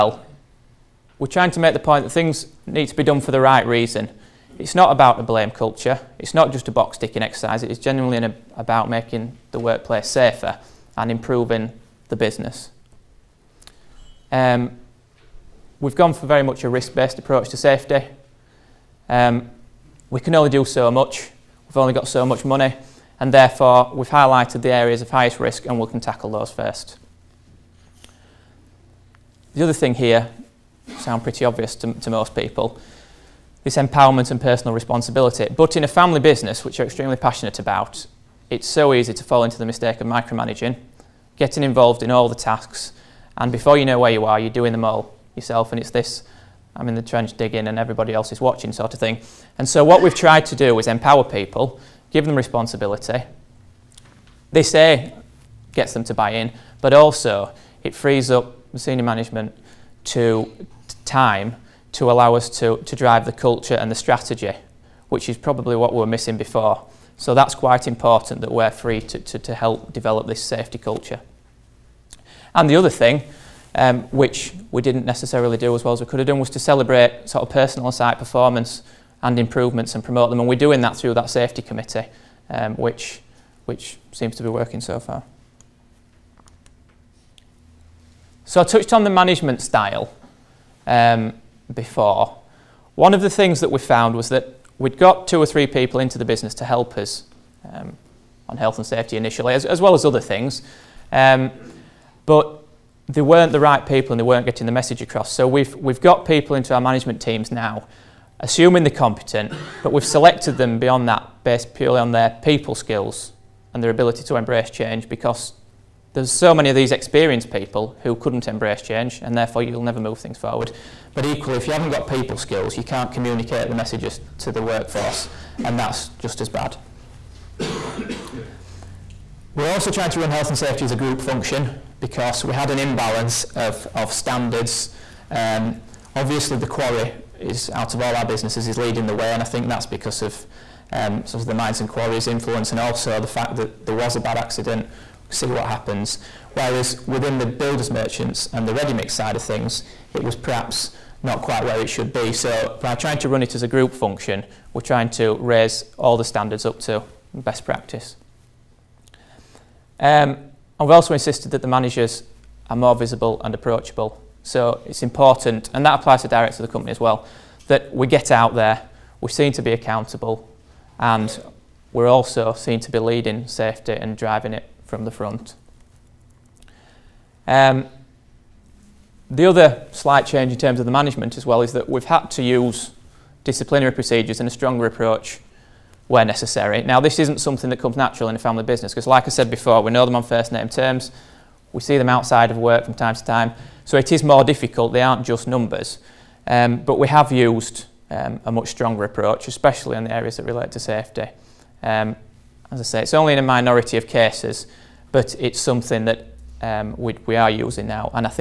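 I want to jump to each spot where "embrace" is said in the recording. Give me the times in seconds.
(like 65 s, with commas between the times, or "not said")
114 s, 118 s.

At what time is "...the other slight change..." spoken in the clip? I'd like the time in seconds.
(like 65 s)
179 s.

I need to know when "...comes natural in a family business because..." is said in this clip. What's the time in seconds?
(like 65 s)
187 s.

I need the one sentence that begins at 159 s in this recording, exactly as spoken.
Um, and we also insisted that the managers are more visible and approachable.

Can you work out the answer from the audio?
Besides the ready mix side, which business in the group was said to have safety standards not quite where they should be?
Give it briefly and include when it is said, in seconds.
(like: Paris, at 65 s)
builders merchants, at 147 s.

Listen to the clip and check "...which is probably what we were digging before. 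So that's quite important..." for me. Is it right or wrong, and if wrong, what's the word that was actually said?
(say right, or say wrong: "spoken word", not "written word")
wrong: "missing", not "digging".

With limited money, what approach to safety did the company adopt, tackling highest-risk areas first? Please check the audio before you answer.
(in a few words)
risk based approach.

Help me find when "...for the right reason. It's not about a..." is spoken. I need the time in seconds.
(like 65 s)
3 s.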